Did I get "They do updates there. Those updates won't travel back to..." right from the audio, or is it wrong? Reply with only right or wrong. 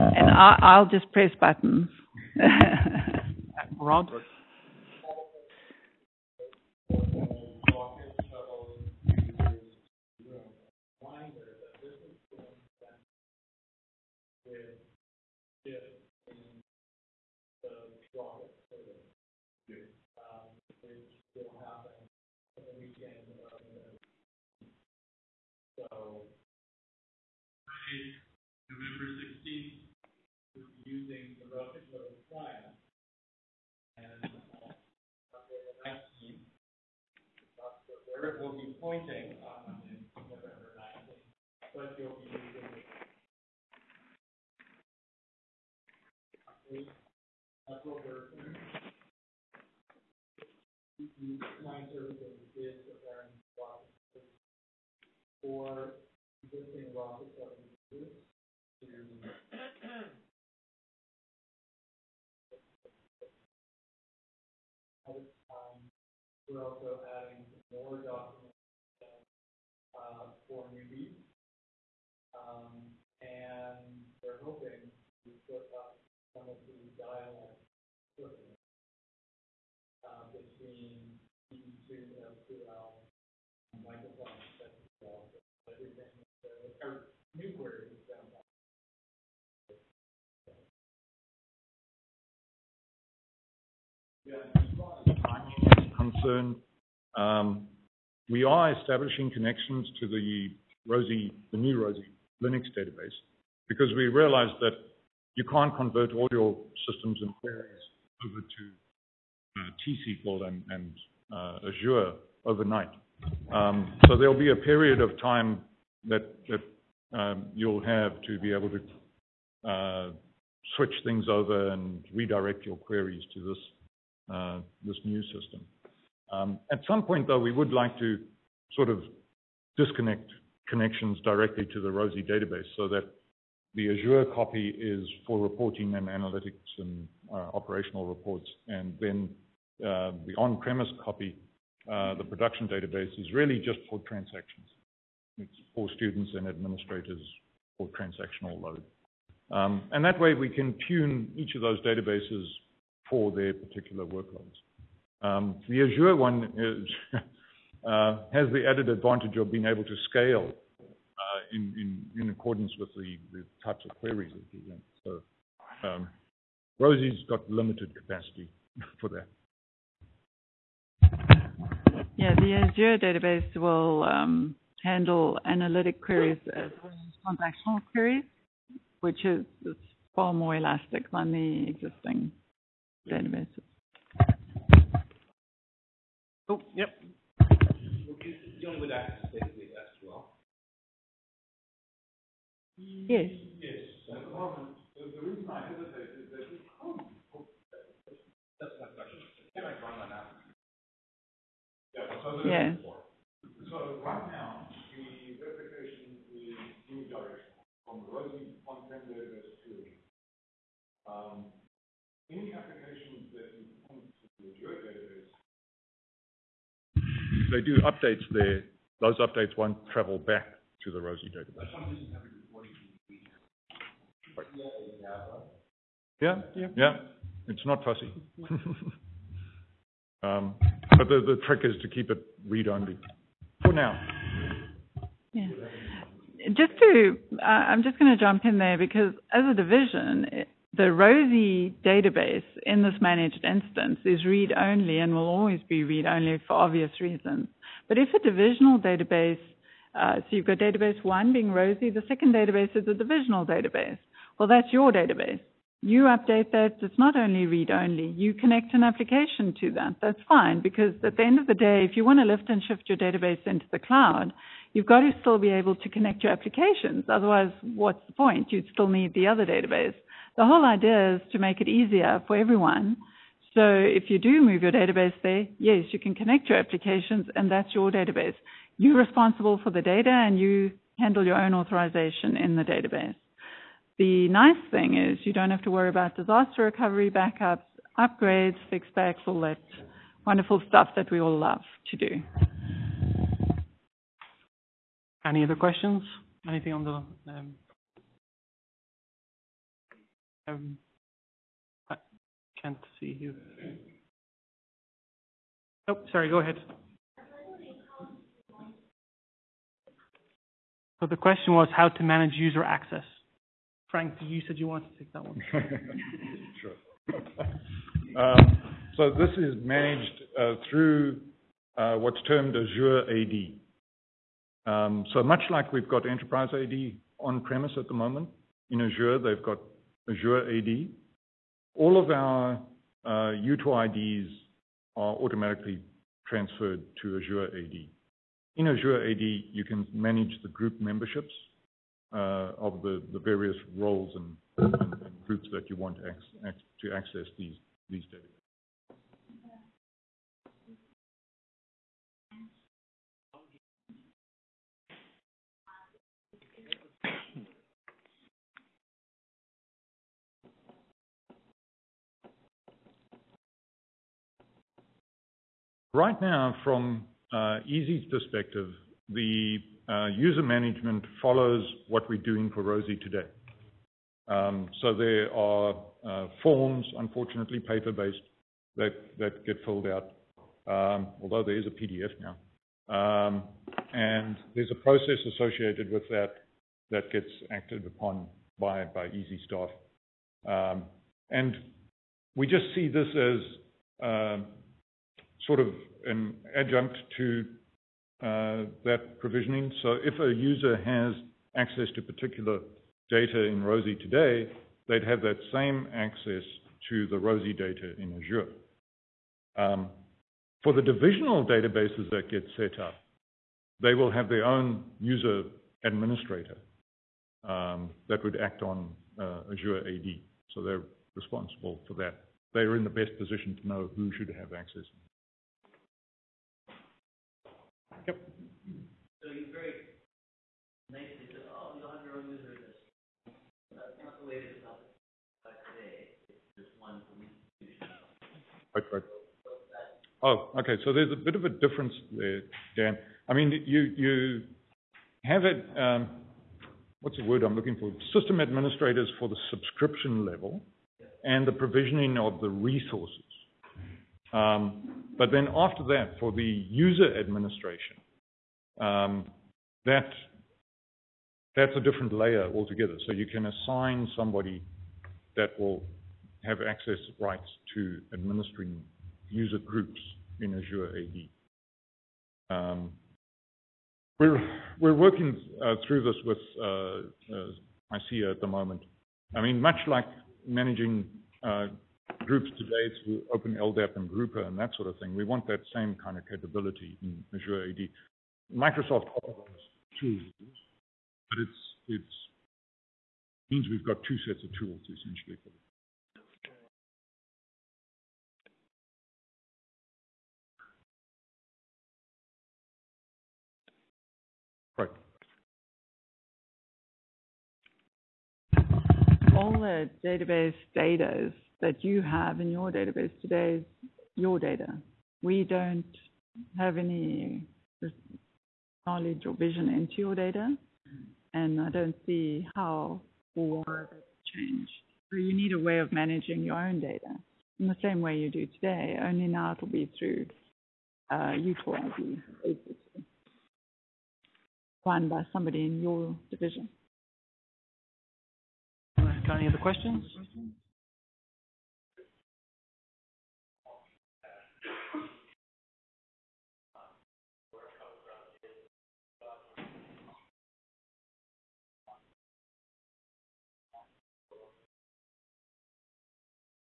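right.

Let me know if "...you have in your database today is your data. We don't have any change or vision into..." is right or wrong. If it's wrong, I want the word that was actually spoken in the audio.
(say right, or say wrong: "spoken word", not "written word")
wrong: "knowledge", not "change".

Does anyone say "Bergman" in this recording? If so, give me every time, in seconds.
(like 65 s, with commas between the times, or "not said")
48 s.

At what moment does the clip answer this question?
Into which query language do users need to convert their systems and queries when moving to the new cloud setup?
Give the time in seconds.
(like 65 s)
109 s.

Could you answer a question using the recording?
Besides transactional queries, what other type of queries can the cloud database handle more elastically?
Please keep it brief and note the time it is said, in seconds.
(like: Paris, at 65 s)
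Analytic queries, at 175 s.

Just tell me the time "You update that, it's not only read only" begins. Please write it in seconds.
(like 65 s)
255 s.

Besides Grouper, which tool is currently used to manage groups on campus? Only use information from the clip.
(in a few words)
Open LDAP.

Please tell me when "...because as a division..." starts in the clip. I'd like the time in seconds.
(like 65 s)
238 s.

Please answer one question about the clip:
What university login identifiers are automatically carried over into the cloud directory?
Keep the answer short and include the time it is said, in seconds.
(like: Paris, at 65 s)
UTORids, at 333 s.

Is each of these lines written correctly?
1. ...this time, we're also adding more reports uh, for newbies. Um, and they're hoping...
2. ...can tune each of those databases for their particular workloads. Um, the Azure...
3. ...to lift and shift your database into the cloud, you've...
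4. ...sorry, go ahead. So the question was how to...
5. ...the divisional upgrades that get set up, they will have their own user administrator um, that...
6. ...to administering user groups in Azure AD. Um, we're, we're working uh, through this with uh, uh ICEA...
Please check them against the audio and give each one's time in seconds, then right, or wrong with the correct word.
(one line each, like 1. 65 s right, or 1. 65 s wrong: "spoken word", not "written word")
1. 65 s wrong: "documents", not "reports"
2. 150 s right
3. 262 s right
4. 306 s right
5. 410 s wrong: "databases", not "upgrades"
6. 467 s right.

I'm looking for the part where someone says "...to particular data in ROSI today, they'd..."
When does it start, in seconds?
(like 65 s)
401 s.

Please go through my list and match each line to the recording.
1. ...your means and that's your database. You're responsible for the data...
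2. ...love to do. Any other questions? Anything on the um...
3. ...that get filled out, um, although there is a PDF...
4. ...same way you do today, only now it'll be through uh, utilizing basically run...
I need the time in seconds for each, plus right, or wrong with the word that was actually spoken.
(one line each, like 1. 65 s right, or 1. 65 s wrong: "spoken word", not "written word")
1. 276 s wrong: "applications", not "means"
2. 291 s right
3. 378 s right
4. 527 s right.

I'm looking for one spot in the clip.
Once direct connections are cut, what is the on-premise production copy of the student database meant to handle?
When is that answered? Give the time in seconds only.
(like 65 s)
144 s.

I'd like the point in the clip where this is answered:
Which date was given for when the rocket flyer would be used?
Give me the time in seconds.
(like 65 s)
27 s.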